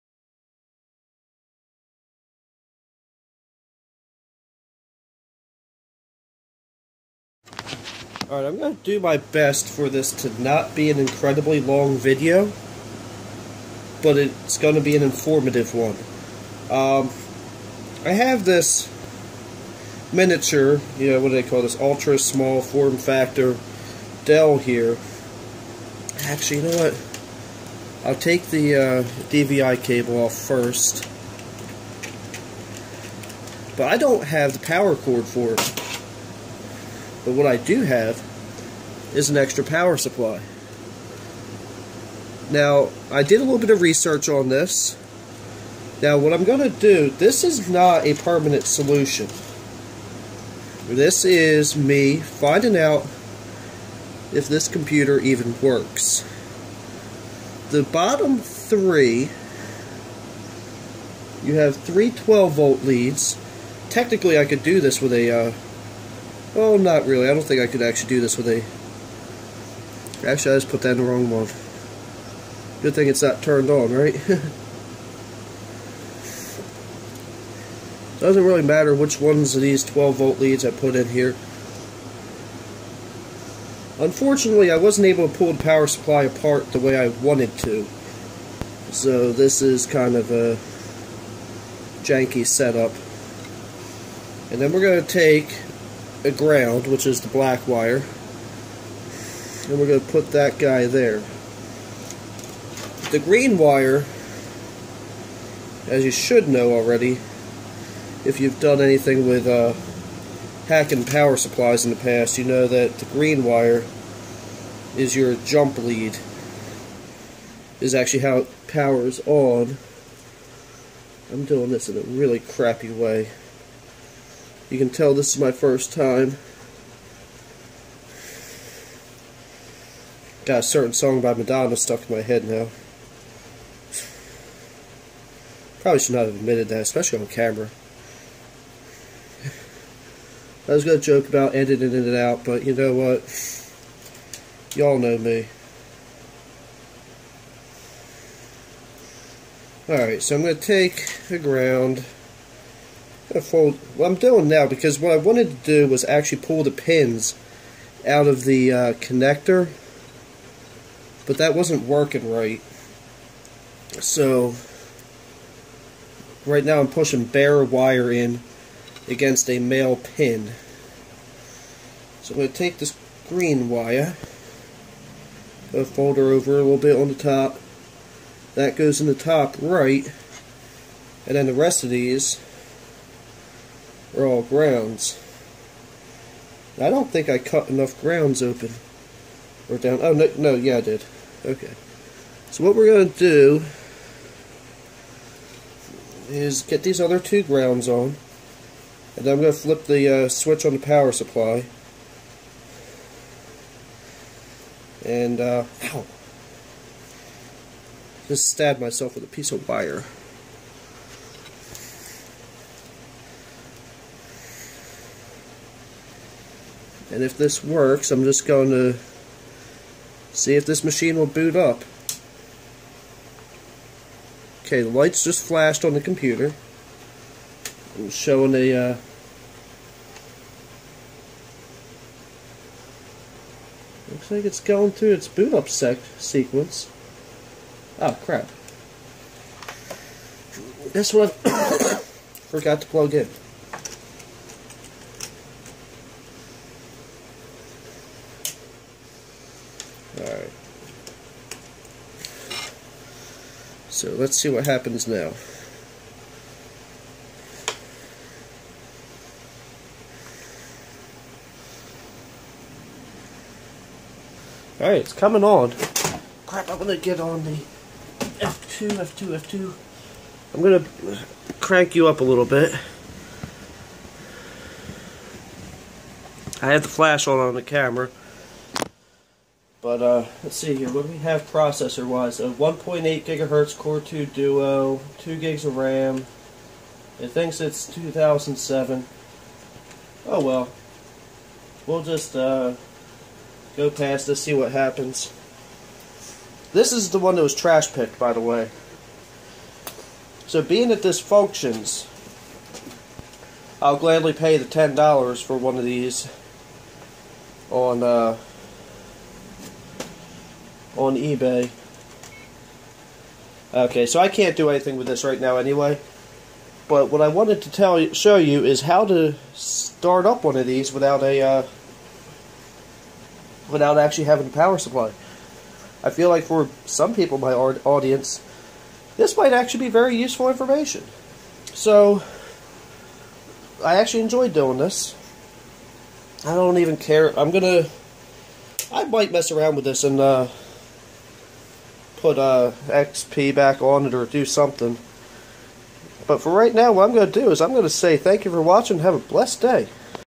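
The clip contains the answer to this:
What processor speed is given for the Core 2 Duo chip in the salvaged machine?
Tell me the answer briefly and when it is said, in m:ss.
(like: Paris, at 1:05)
1.8 gigahertz, at 4:42.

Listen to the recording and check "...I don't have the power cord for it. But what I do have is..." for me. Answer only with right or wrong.
right.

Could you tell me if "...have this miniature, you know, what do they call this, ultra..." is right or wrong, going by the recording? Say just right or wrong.
right.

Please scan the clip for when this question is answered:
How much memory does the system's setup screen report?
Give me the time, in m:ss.
4:45.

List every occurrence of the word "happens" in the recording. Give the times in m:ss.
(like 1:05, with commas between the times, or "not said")
4:14, 4:54.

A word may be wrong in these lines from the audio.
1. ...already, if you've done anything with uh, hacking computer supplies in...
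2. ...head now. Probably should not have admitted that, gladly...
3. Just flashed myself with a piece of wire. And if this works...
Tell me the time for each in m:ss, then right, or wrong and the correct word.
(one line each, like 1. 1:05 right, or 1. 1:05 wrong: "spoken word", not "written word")
1. 1:46 wrong: "power", not "computer"
2. 2:12 wrong: "especially", not "gladly"
3. 3:28 wrong: "stabbed", not "flashed".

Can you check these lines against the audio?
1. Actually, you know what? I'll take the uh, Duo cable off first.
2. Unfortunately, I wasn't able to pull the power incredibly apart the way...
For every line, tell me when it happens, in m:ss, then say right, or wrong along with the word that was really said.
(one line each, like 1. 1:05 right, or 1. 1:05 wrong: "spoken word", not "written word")
1. 0:26 wrong: "DVI", not "Duo"
2. 1:23 wrong: "supply", not "incredibly".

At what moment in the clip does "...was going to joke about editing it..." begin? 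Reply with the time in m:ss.
2:20.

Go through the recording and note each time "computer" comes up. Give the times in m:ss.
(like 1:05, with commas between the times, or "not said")
0:54, 3:45.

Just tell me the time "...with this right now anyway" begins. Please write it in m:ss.
5:14.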